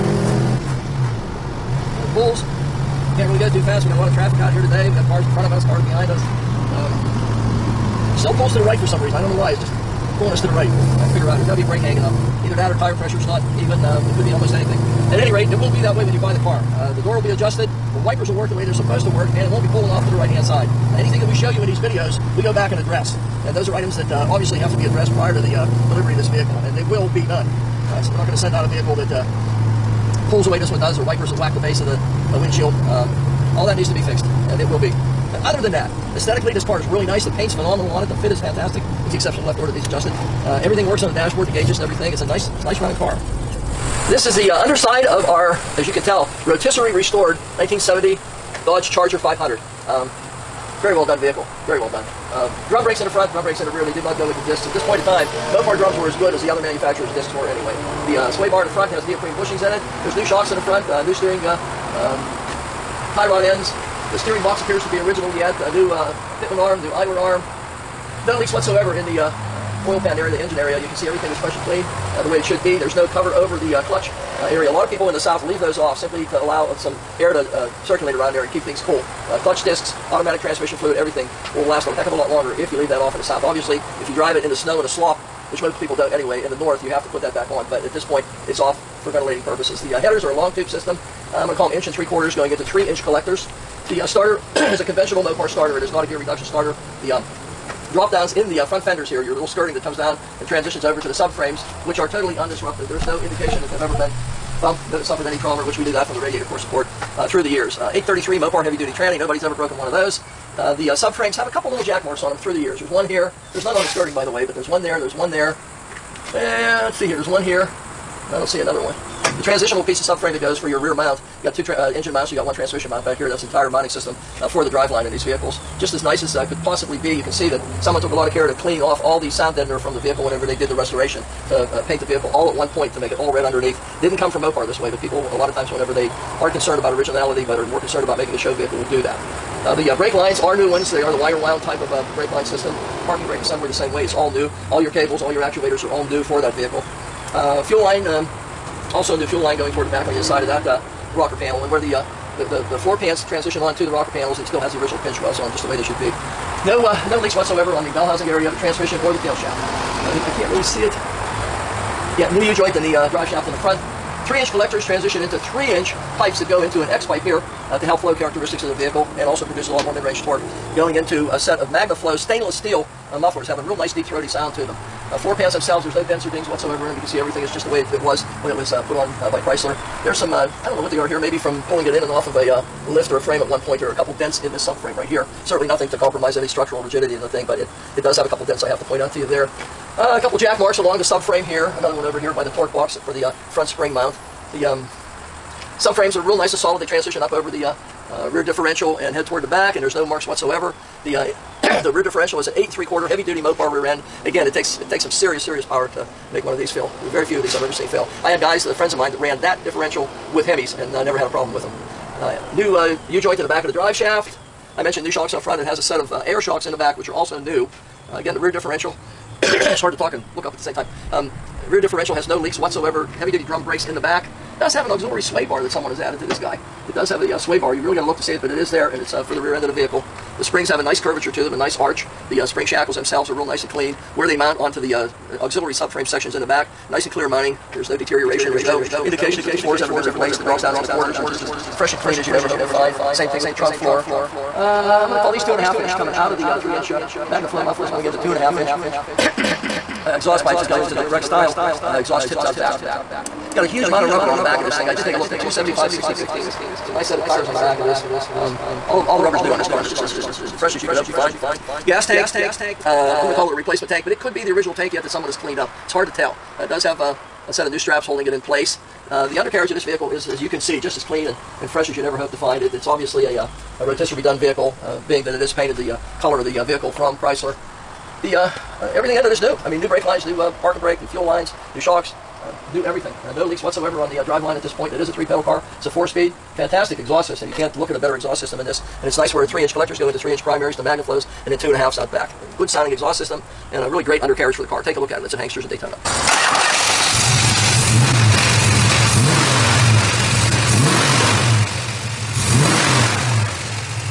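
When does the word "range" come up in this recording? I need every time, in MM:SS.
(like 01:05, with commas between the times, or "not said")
02:49.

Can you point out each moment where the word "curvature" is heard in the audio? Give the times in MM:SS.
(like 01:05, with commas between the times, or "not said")
03:50.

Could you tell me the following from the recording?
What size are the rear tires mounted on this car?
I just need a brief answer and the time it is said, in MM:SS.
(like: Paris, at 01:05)
275/60/15, at 04:15.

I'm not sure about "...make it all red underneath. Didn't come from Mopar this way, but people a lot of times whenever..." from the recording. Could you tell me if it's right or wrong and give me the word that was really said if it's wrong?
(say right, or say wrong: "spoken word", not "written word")
right.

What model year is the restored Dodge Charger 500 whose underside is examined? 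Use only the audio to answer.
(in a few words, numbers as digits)
1970.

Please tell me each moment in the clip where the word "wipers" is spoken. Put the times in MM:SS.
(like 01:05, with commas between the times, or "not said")
00:18, 00:31.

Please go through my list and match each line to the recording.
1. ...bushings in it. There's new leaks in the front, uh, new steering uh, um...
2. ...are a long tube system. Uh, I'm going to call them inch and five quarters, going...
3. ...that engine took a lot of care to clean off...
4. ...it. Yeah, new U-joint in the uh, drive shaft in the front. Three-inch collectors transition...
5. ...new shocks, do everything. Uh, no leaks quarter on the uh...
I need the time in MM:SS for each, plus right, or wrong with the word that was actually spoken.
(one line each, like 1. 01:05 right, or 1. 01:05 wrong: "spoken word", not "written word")
1. 00:59 wrong: "shocks", not "leaks"
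2. 01:30 wrong: "three", not "five"
3. 02:07 wrong: "someone", not "engine"
4. 02:40 right
5. 04:41 wrong: "whatsoever", not "quarter".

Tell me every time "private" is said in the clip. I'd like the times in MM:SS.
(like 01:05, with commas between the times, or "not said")
not said.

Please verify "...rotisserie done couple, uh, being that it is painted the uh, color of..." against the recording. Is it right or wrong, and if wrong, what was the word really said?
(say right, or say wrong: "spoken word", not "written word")
wrong: "vehicle", not "couple".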